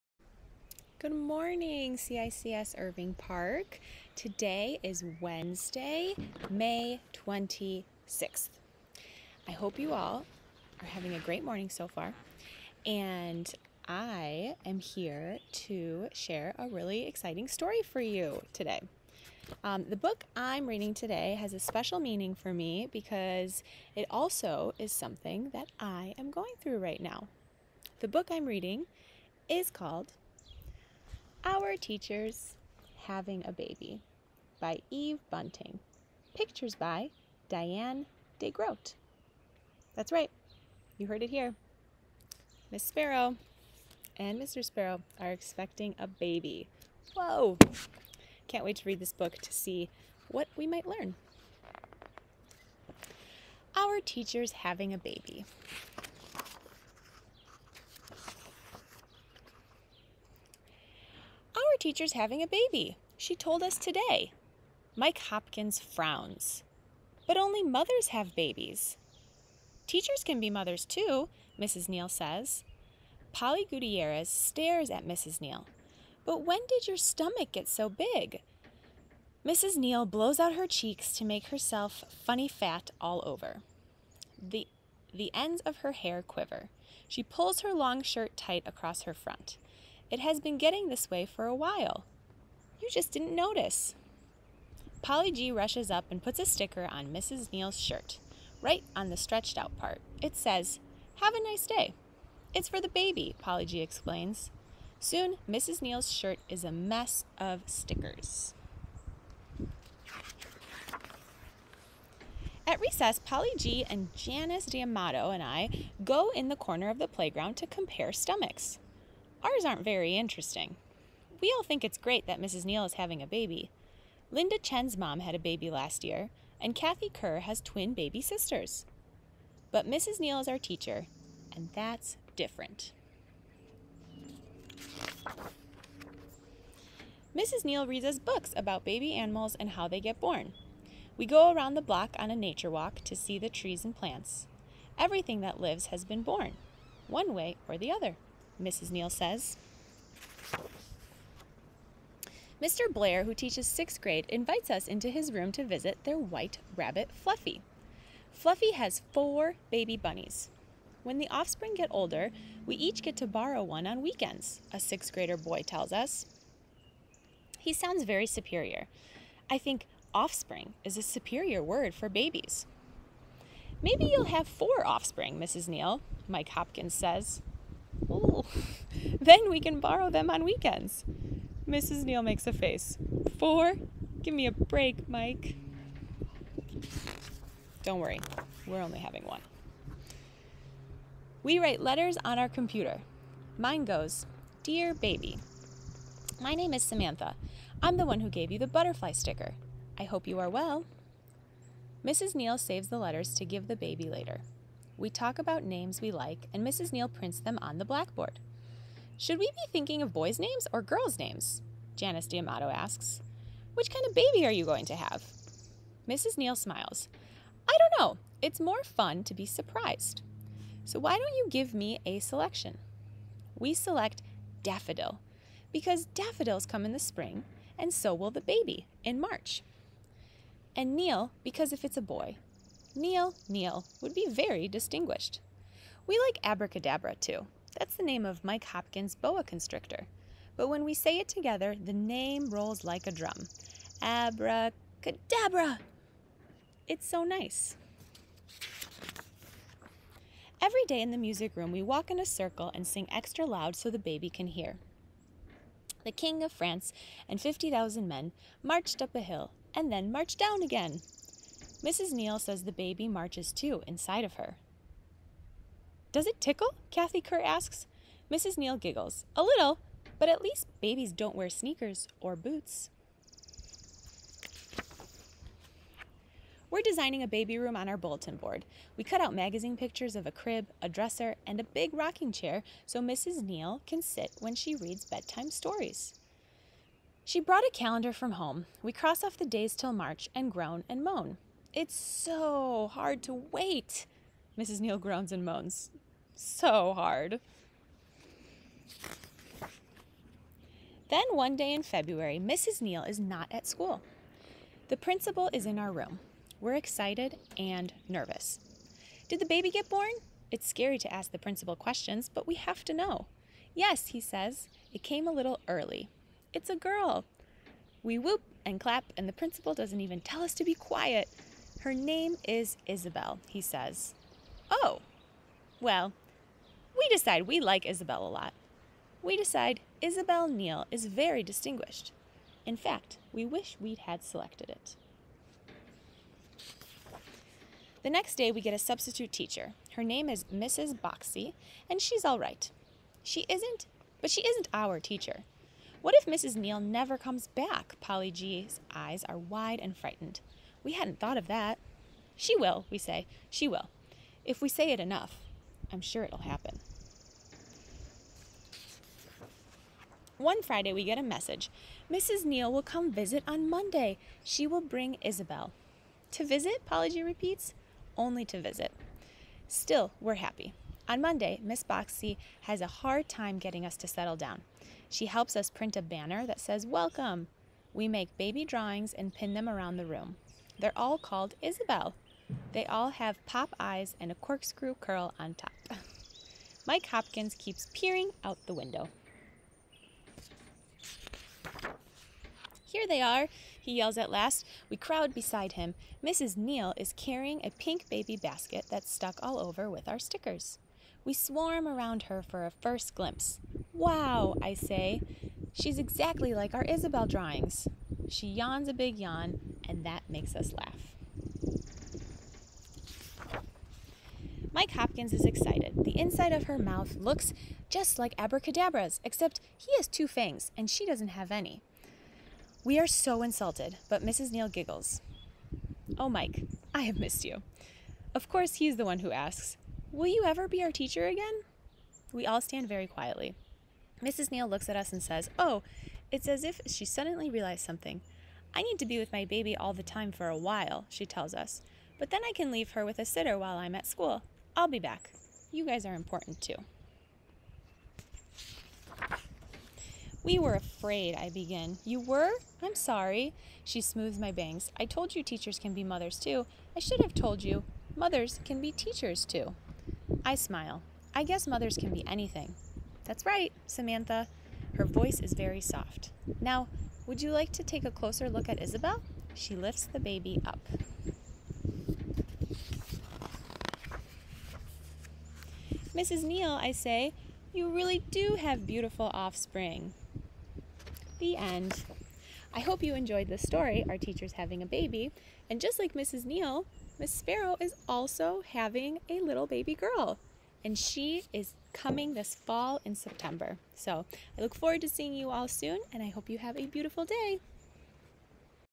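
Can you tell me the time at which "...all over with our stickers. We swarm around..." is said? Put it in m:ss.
6:39.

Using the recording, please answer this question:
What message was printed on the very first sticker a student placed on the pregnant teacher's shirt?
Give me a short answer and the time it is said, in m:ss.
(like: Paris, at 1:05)
Have a nice day, at 1:41.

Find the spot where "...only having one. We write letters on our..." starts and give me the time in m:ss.
3:08.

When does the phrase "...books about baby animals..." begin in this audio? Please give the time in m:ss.
2:18.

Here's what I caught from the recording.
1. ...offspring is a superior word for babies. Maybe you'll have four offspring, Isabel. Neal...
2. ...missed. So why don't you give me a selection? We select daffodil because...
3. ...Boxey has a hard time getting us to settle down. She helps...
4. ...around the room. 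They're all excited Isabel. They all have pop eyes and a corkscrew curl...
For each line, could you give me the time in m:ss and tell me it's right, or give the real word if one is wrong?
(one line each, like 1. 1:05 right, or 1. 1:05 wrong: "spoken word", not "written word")
1. 2:50 wrong: "Mrs", not "Isabel"
2. 3:39 wrong: "surprised", not "missed"
3. 6:11 right
4. 6:19 wrong: "called", not "excited".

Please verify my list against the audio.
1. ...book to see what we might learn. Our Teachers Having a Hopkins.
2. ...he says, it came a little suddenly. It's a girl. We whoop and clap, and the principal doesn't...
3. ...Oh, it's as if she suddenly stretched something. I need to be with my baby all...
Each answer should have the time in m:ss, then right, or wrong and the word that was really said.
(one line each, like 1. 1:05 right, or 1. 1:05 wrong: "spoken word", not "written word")
1. 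0:49 wrong: "Baby", not "Hopkins"
2. 5:14 wrong: "early", not "suddenly"
3. 7:15 wrong: "realized", not "stretched".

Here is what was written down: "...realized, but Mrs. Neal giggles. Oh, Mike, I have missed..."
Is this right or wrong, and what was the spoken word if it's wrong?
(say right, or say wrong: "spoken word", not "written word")
wrong: "insulted", not "realized".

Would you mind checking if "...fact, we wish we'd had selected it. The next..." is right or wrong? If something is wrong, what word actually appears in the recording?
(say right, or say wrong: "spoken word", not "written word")
right.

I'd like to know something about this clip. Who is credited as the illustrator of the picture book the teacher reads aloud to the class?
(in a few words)
Diane DeGroat.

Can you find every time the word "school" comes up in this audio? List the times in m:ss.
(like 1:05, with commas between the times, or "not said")
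5:03, 7:24.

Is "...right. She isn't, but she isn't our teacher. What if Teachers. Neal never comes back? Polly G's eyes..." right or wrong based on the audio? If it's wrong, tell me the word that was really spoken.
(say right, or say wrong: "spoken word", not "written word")
wrong: "Mrs", not "Teachers".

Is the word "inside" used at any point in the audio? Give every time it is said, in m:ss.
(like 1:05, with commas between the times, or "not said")
4:23, 6:56.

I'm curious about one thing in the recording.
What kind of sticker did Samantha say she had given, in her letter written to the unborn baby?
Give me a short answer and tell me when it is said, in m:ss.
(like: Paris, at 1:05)
butterfly, at 3:18.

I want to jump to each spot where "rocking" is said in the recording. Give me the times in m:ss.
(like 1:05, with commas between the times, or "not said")
4:41.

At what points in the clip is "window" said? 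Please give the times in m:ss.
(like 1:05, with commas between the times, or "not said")
6:28.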